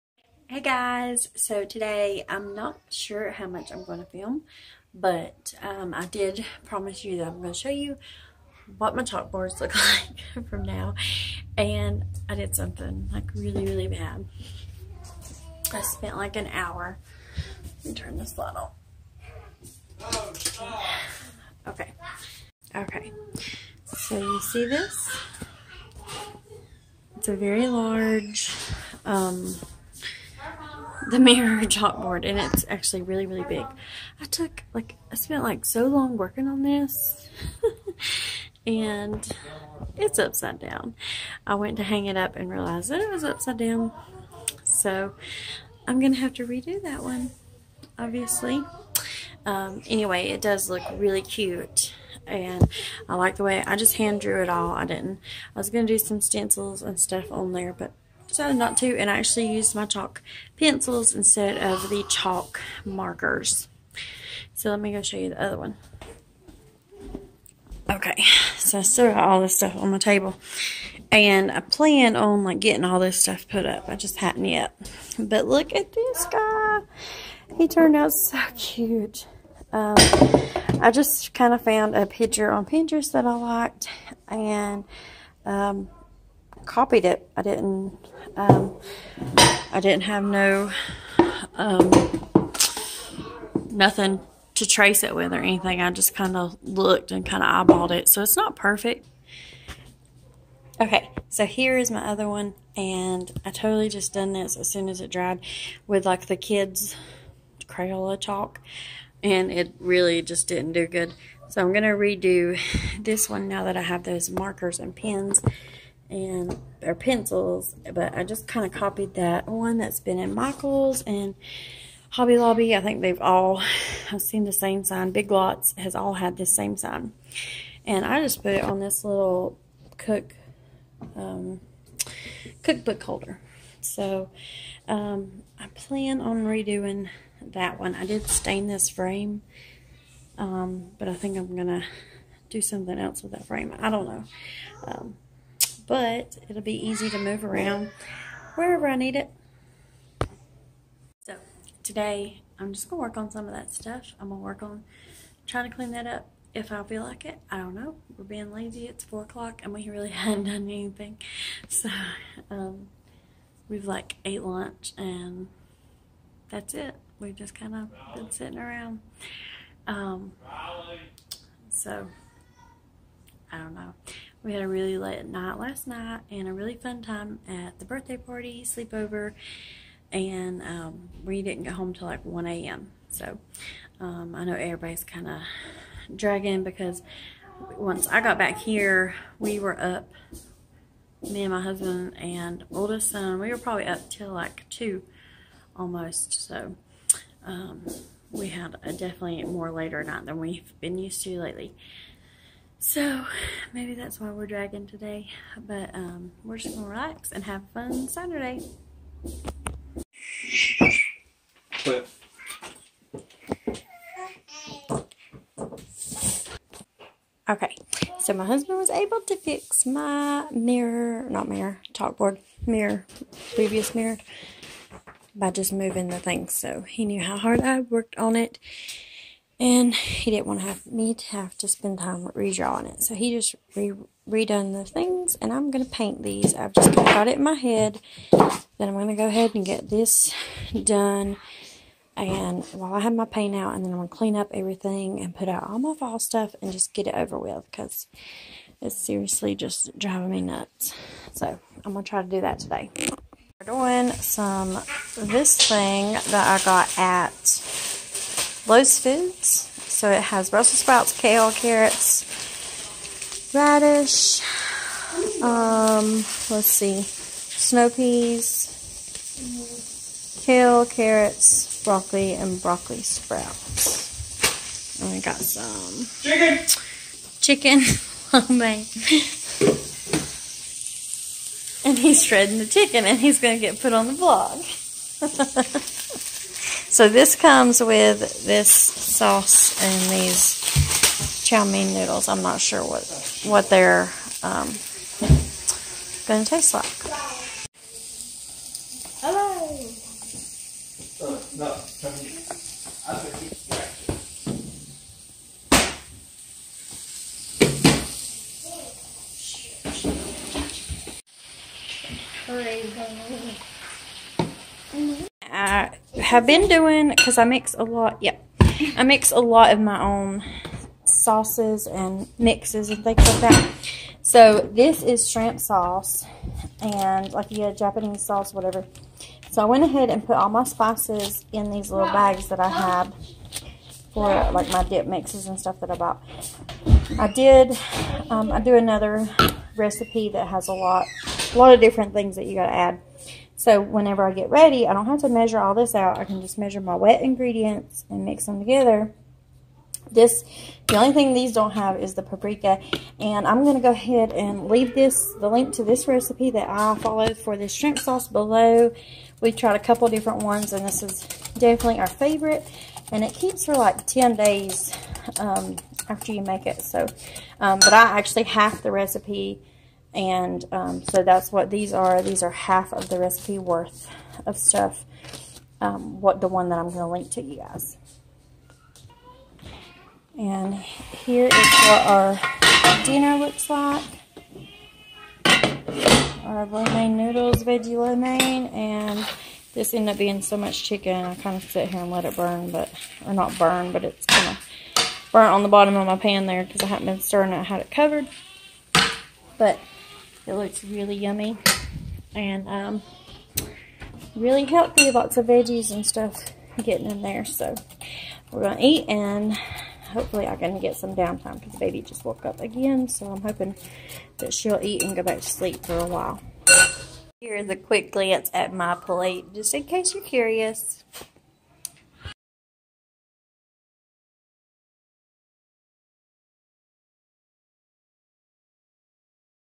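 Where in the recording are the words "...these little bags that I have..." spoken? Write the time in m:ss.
5:31.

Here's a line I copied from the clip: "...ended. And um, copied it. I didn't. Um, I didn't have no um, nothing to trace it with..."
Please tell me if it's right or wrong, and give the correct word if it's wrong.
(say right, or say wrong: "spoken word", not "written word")
wrong: "liked", not "ended".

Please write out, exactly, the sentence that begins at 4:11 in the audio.
So I'm gonna try to do that today.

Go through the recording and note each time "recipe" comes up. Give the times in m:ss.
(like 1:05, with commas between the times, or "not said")
5:39, 5:56, 6:08, 6:13.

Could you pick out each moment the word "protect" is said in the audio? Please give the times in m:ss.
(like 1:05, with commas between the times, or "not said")
not said.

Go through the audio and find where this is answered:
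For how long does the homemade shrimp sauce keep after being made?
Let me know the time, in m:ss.
6:04.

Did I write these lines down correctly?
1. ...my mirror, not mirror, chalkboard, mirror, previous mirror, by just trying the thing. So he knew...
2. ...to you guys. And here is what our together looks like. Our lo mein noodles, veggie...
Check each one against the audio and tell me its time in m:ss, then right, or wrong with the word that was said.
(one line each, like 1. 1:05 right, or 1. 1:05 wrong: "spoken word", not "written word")
1. 3:39 wrong: "moving", not "trying"
2. 6:17 wrong: "dinner", not "together".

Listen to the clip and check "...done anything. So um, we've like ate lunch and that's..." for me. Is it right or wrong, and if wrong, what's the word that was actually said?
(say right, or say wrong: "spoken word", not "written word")
right.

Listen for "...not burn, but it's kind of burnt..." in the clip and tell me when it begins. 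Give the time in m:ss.
6:33.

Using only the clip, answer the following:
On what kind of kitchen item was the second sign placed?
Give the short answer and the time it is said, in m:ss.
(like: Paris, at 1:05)
cookbook holder, at 2:12.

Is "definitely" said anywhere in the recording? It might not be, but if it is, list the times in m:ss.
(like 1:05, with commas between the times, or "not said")
3:18, 6:01.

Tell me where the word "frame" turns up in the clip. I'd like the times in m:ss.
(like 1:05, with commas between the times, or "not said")
2:18, 2:23.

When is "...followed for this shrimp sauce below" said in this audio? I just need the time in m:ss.
5:56.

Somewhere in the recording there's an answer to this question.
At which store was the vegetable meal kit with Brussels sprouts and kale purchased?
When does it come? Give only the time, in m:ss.
4:18.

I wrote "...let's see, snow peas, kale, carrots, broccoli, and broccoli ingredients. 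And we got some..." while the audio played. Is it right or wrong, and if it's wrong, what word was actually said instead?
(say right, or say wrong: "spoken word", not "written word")
wrong: "sprouts", not "ingredients".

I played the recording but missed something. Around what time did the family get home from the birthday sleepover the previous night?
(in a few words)
1 a.m.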